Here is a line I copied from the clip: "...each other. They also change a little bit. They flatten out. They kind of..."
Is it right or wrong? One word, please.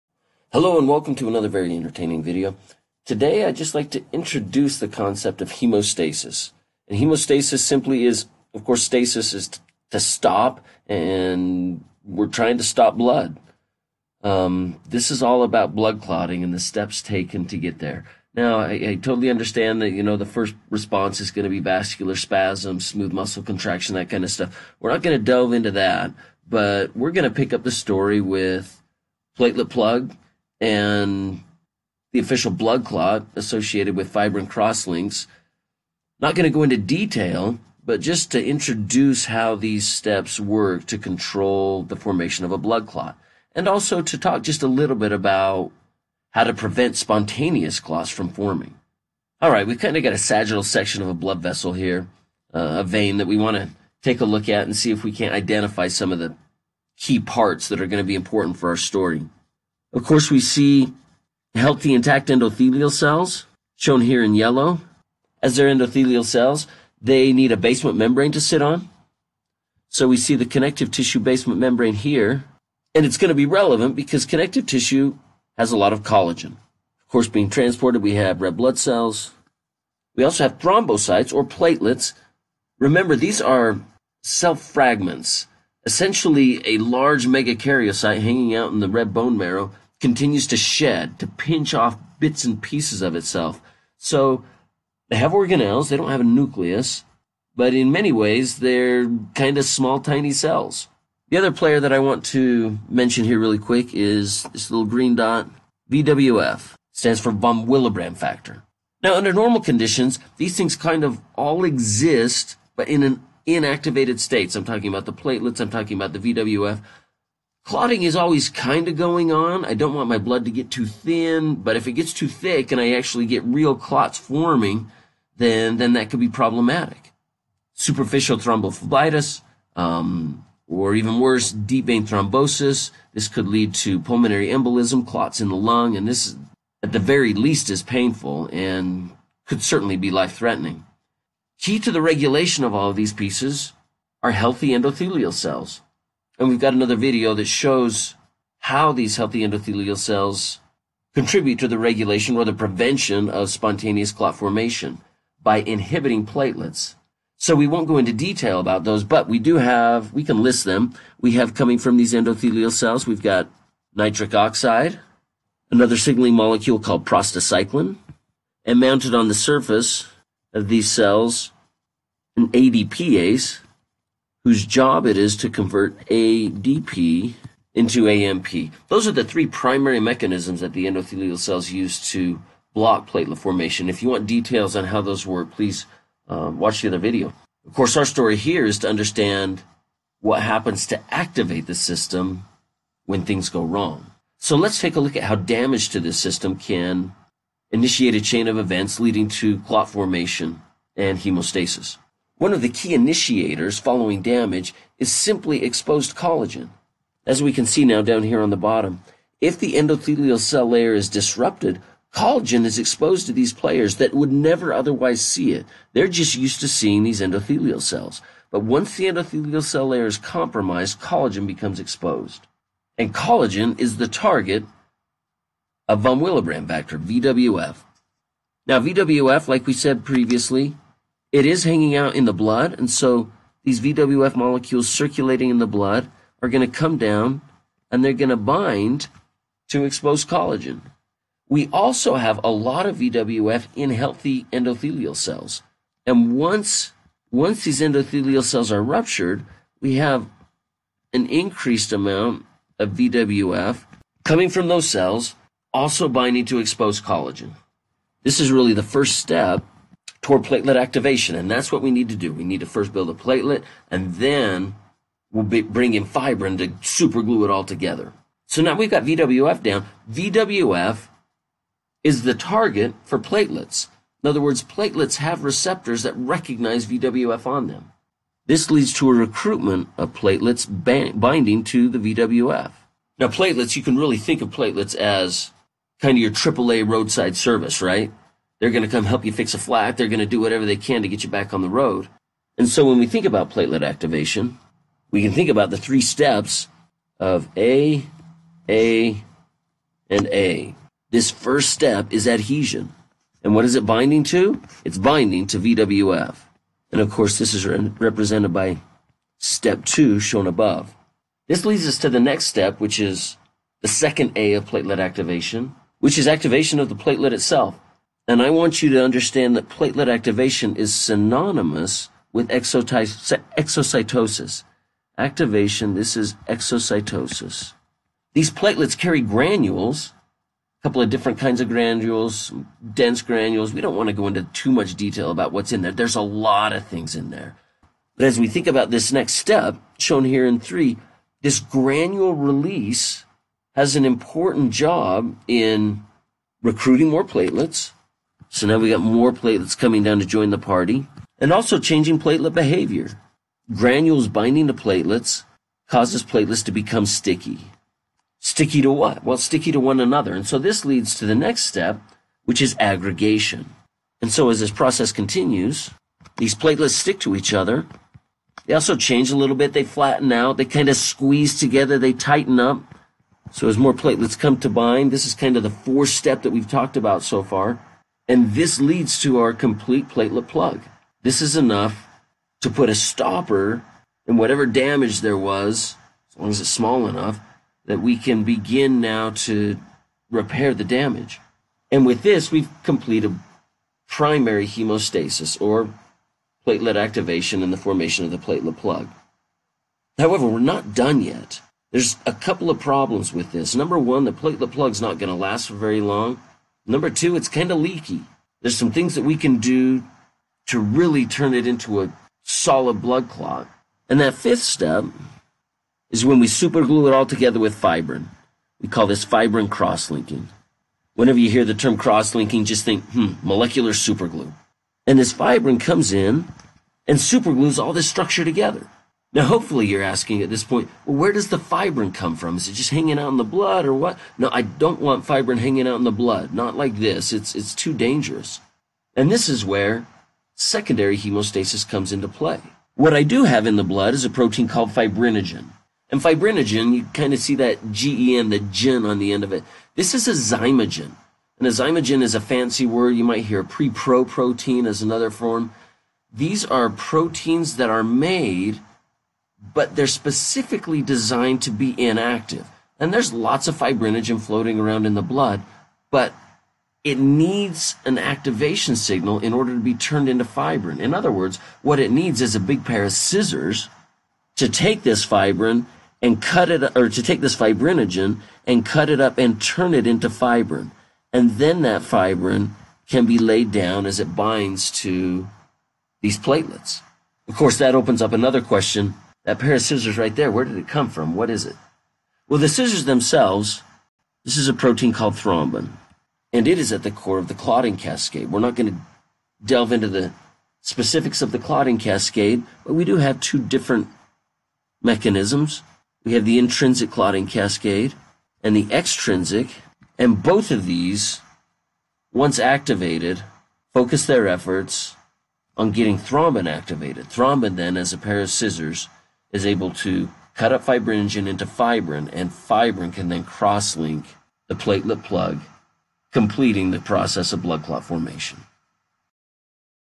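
right.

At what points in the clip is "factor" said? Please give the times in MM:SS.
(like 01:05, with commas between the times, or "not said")
01:48, 03:46.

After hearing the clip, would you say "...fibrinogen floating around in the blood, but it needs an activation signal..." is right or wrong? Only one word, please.
right.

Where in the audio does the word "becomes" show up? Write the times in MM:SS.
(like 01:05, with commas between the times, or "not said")
03:41, 05:56.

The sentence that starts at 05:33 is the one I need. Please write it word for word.
We don't want to go into too much detail about what's in there.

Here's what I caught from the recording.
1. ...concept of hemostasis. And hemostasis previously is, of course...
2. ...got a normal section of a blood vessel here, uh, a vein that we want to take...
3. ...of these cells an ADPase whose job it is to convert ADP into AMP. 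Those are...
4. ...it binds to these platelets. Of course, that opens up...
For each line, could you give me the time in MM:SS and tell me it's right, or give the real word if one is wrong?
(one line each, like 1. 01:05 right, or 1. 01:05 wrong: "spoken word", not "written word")
1. 00:04 wrong: "simply", not "previously"
2. 00:50 wrong: "sagittal", not "normal"
3. 02:50 right
4. 08:04 right.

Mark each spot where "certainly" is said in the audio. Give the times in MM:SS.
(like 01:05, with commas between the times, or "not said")
02:19.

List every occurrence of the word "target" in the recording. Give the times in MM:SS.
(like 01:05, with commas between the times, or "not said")
03:44, 04:32.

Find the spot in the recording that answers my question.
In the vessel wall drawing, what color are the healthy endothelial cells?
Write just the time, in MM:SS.
01:04.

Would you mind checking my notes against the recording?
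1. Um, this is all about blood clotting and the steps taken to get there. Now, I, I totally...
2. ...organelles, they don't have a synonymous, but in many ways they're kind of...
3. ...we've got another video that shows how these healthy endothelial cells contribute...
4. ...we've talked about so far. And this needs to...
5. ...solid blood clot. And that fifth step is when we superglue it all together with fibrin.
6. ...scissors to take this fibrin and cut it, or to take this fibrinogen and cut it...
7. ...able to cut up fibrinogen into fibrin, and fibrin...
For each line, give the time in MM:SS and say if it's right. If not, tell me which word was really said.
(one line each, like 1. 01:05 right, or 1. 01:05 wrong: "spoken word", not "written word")
1. 00:14 right
2. 01:35 wrong: "nucleus", not "synonymous"
3. 02:26 right
4. 06:16 wrong: "leads", not "needs"
5. 06:52 right
6. 07:53 right
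7. 08:39 right.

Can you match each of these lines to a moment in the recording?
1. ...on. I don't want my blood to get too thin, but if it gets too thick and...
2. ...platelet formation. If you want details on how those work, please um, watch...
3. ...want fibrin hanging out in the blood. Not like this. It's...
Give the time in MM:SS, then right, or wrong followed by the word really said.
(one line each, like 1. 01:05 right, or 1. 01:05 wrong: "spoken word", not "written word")
1. 01:59 right
2. 03:03 right
3. 07:14 right.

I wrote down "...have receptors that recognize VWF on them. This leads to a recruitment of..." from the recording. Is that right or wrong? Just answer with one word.
right.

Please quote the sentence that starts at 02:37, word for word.
So we won't go into detail about those, but we do have, we can list them.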